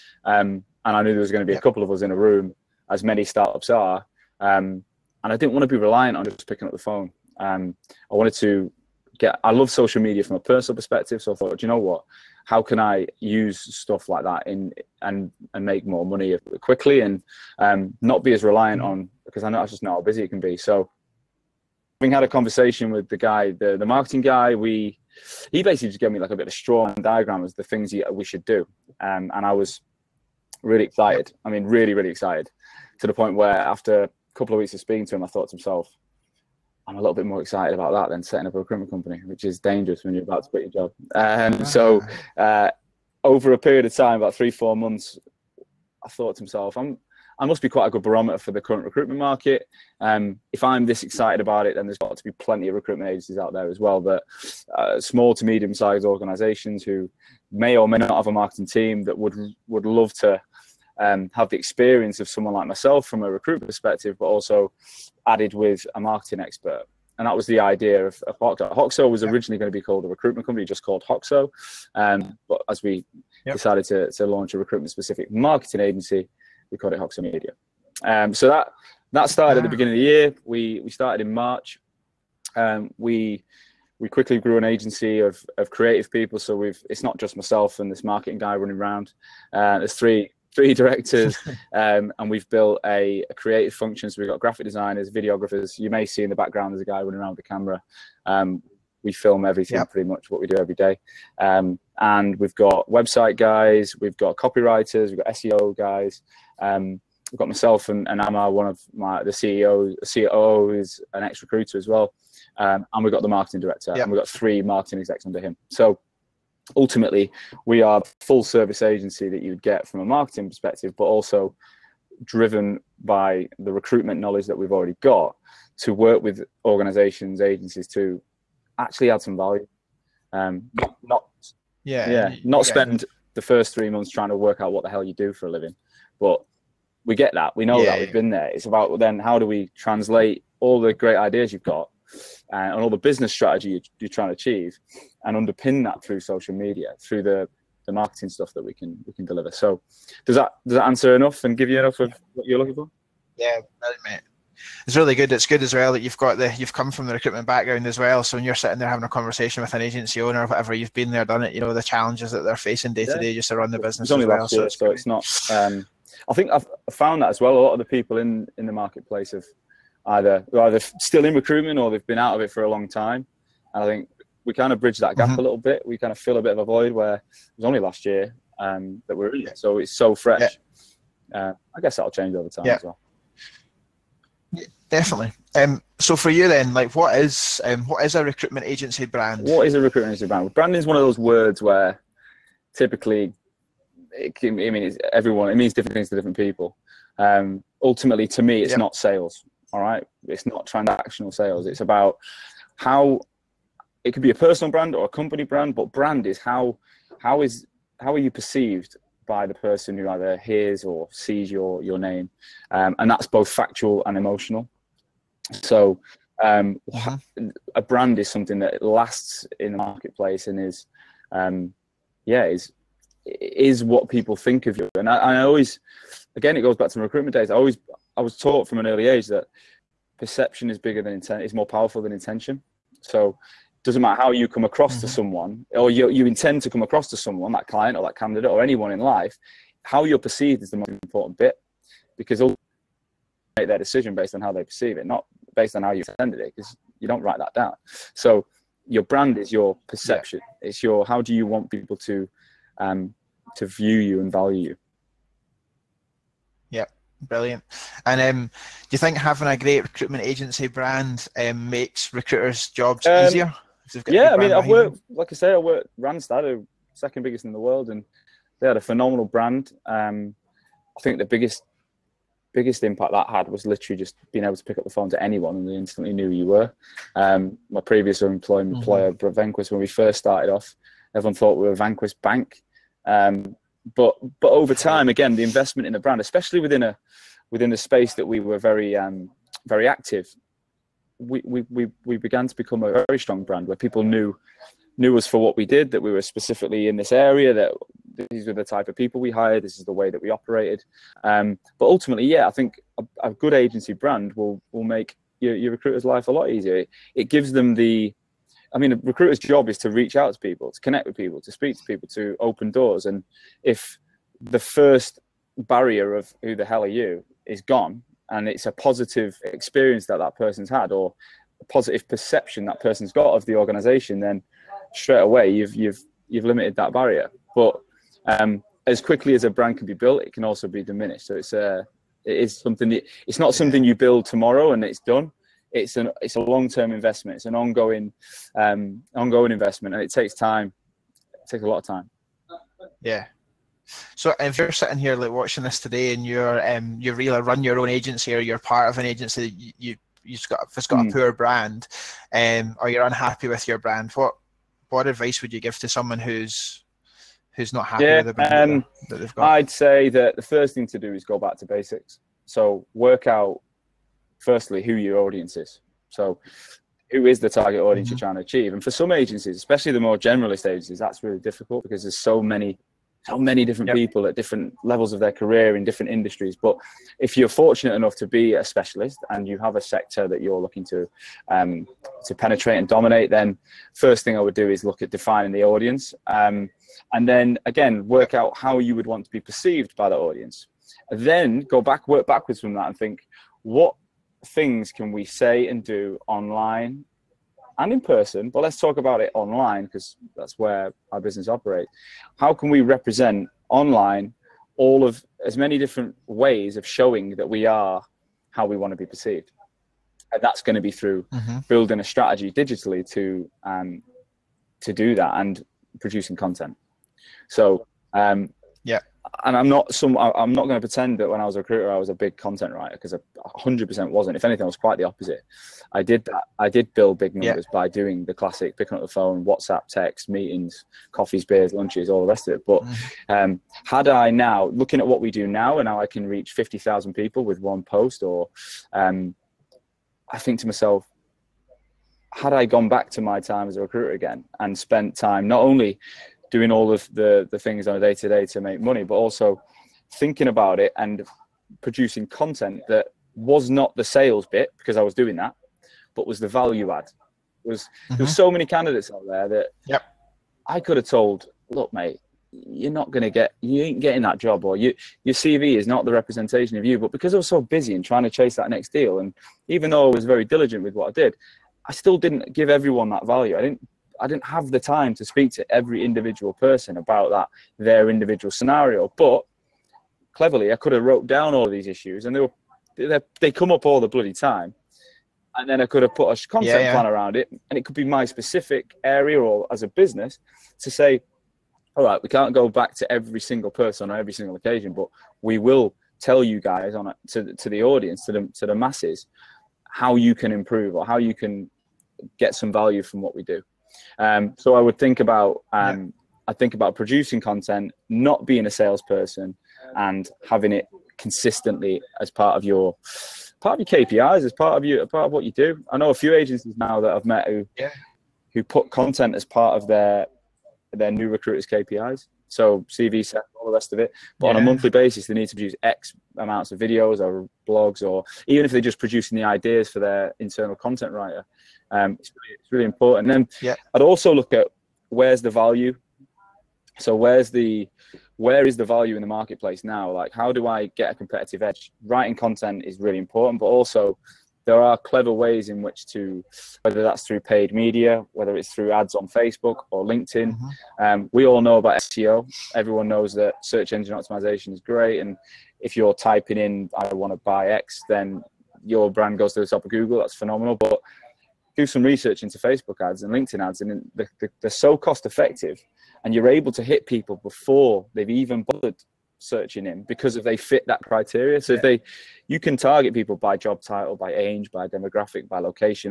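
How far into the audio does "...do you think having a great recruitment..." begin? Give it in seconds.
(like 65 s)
258 s.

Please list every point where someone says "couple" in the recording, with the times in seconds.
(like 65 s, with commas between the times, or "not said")
1 s, 34 s.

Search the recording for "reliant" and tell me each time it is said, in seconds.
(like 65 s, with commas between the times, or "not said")
5 s, 18 s.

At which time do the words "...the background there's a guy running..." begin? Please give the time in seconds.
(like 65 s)
96 s.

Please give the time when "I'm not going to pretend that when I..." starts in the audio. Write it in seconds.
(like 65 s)
420 s.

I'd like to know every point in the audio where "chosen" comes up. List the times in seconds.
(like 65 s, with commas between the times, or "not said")
not said.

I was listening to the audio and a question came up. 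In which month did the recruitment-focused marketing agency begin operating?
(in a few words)
March.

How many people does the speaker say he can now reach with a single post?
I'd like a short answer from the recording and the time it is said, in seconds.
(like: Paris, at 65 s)
50,000, at 436 s.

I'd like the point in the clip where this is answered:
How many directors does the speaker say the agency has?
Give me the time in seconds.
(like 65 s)
89 s.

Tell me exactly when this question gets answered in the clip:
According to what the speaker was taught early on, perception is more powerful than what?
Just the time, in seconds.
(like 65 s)
232 s.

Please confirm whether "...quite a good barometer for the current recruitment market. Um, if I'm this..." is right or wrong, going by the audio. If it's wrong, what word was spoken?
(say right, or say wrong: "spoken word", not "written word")
right.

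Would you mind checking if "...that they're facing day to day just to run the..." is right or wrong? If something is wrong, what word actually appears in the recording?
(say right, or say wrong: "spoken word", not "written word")
right.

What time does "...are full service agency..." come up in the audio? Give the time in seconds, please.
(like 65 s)
117 s.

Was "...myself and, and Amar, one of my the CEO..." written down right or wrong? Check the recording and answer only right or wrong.
right.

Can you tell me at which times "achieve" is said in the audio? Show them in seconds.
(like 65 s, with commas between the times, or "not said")
144 s, 368 s.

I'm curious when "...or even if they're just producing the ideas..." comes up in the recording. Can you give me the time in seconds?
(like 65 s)
528 s.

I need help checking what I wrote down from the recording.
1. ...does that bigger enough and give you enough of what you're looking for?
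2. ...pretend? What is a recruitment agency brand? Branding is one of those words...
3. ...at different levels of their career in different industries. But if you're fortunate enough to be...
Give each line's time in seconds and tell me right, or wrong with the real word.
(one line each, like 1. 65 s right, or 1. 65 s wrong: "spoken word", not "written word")
1. 150 s wrong: "answer", not "bigger"
2. 189 s wrong: "brand", not "pretend"
3. 374 s right.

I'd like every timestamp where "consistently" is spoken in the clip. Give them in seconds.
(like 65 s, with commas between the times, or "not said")
511 s.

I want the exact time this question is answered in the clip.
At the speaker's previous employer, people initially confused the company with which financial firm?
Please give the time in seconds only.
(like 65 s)
281 s.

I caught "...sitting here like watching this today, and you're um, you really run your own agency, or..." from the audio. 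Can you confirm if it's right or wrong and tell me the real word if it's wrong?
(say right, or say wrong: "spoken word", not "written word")
right.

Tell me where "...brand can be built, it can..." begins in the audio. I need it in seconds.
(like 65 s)
329 s.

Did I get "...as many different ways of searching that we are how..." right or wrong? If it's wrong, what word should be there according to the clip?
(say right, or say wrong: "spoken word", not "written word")
wrong: "showing", not "searching".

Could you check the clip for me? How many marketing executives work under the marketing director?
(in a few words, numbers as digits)
3.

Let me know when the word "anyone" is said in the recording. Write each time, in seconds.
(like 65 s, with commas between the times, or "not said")
238 s, 275 s.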